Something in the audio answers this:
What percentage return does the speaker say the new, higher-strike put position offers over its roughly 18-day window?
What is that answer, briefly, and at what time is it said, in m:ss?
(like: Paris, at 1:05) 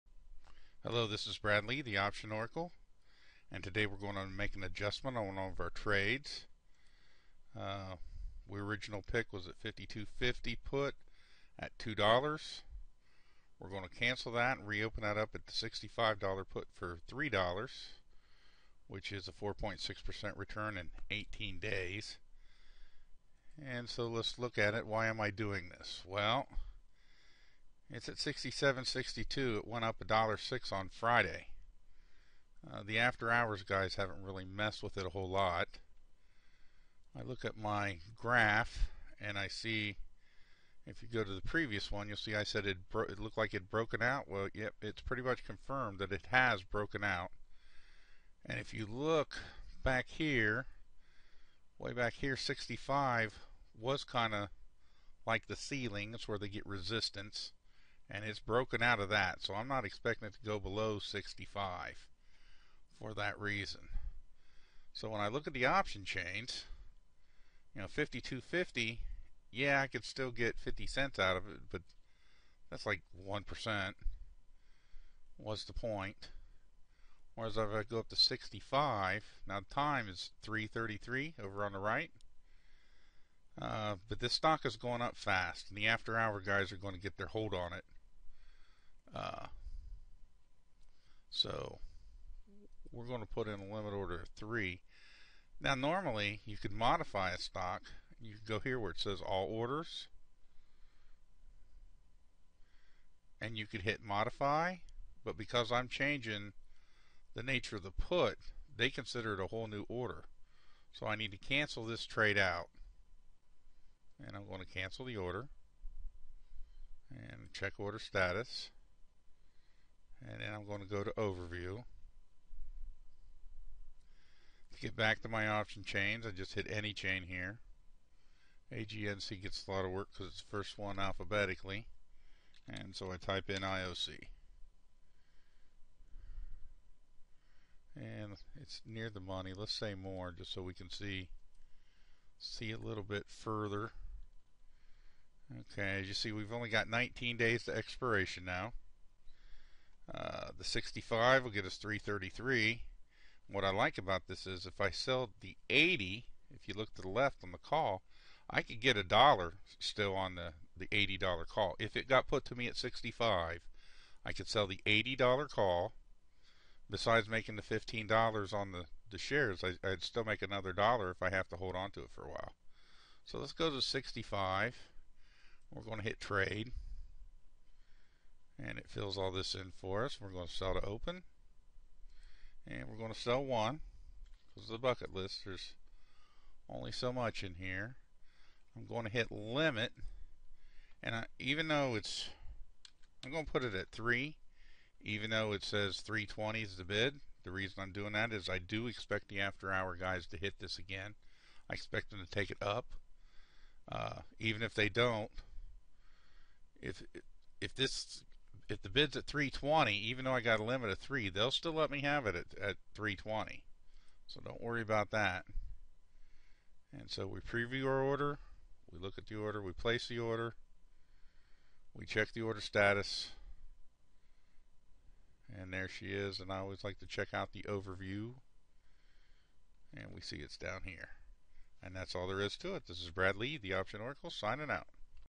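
4.6%, at 0:19.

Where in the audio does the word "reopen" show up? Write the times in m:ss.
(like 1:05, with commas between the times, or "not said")
0:14.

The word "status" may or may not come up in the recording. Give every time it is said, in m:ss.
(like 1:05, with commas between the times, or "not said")
1:57, 3:42.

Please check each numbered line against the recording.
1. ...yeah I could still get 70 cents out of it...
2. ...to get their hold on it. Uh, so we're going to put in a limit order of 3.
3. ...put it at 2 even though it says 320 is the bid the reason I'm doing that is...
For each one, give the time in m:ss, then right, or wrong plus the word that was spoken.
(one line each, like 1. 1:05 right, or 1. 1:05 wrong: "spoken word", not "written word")
1. 1:09 wrong: "50", not "70"
2. 1:26 right
3. 3:13 wrong: "3", not "2".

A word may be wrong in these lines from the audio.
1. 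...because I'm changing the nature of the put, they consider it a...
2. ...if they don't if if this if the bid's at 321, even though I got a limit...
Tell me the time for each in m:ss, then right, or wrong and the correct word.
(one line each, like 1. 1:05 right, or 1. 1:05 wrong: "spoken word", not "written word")
1. 1:45 right
2. 3:24 wrong: "320", not "321".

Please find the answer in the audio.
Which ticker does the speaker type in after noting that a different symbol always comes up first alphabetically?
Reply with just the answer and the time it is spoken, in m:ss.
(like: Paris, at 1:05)
IOC, at 2:13.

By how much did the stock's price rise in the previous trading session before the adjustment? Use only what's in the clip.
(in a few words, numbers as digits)
$1.06.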